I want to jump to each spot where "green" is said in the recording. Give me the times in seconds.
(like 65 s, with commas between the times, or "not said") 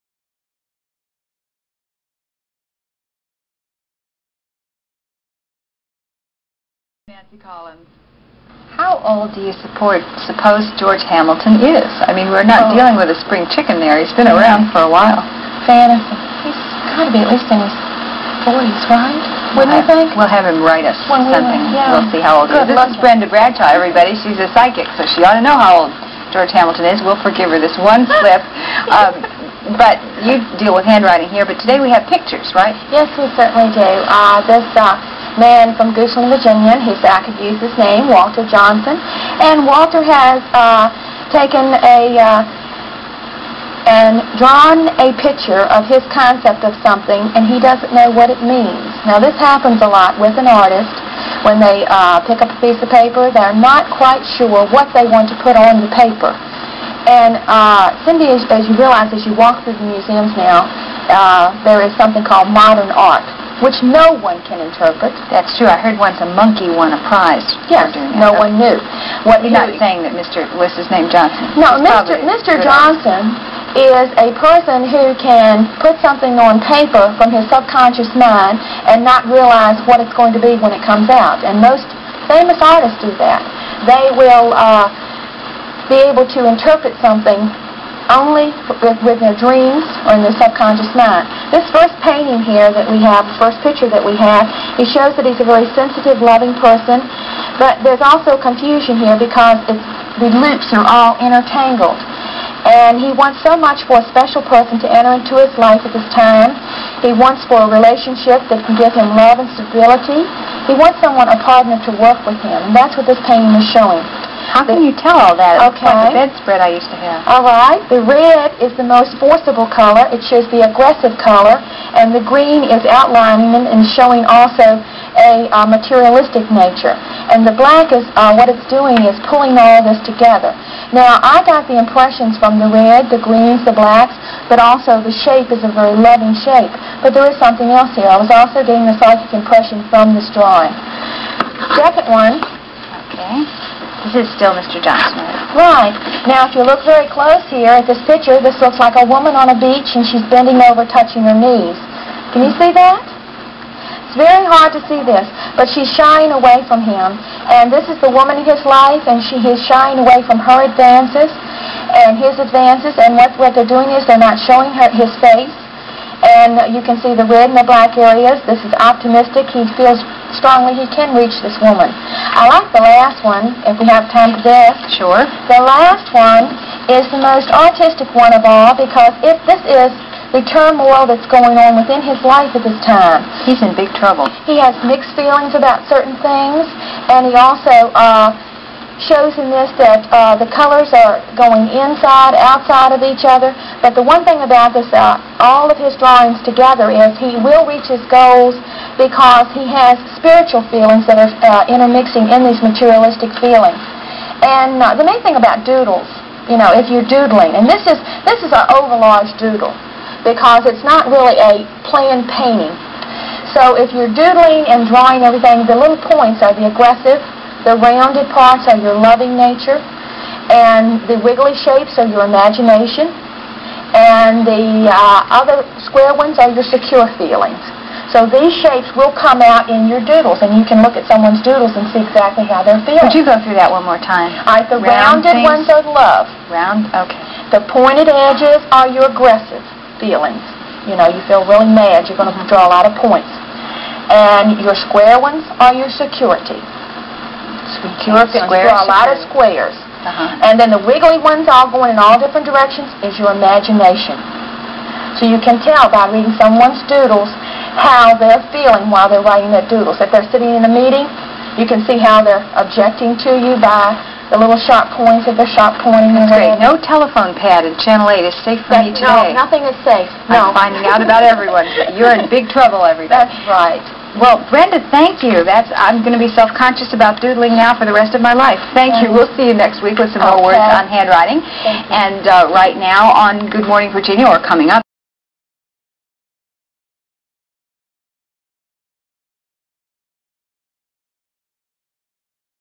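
122 s, 133 s.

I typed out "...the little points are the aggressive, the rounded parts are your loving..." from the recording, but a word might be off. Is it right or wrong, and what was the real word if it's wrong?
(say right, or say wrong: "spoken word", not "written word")
right.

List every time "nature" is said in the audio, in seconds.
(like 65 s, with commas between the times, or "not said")
126 s, 219 s.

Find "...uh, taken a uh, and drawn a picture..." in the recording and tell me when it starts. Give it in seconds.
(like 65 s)
40 s.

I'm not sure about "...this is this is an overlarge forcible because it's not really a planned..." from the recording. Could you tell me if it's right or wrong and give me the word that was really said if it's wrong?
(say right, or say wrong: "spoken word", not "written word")
wrong: "doodle", not "forcible".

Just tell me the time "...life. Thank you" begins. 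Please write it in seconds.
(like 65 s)
278 s.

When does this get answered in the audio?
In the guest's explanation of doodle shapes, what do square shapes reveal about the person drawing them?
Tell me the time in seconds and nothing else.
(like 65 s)
245 s.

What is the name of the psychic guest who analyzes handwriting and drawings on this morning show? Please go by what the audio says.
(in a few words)
Brenda Bradshaw.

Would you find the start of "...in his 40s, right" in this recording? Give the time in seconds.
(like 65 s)
17 s.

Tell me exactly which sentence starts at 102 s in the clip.
And he wants so much for a special person to enter into his life at this time.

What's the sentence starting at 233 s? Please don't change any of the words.
Would you go through that one more time?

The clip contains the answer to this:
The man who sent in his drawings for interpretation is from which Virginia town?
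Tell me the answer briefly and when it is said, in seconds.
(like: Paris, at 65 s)
Goochland, at 35 s.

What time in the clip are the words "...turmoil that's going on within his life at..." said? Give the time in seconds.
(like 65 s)
180 s.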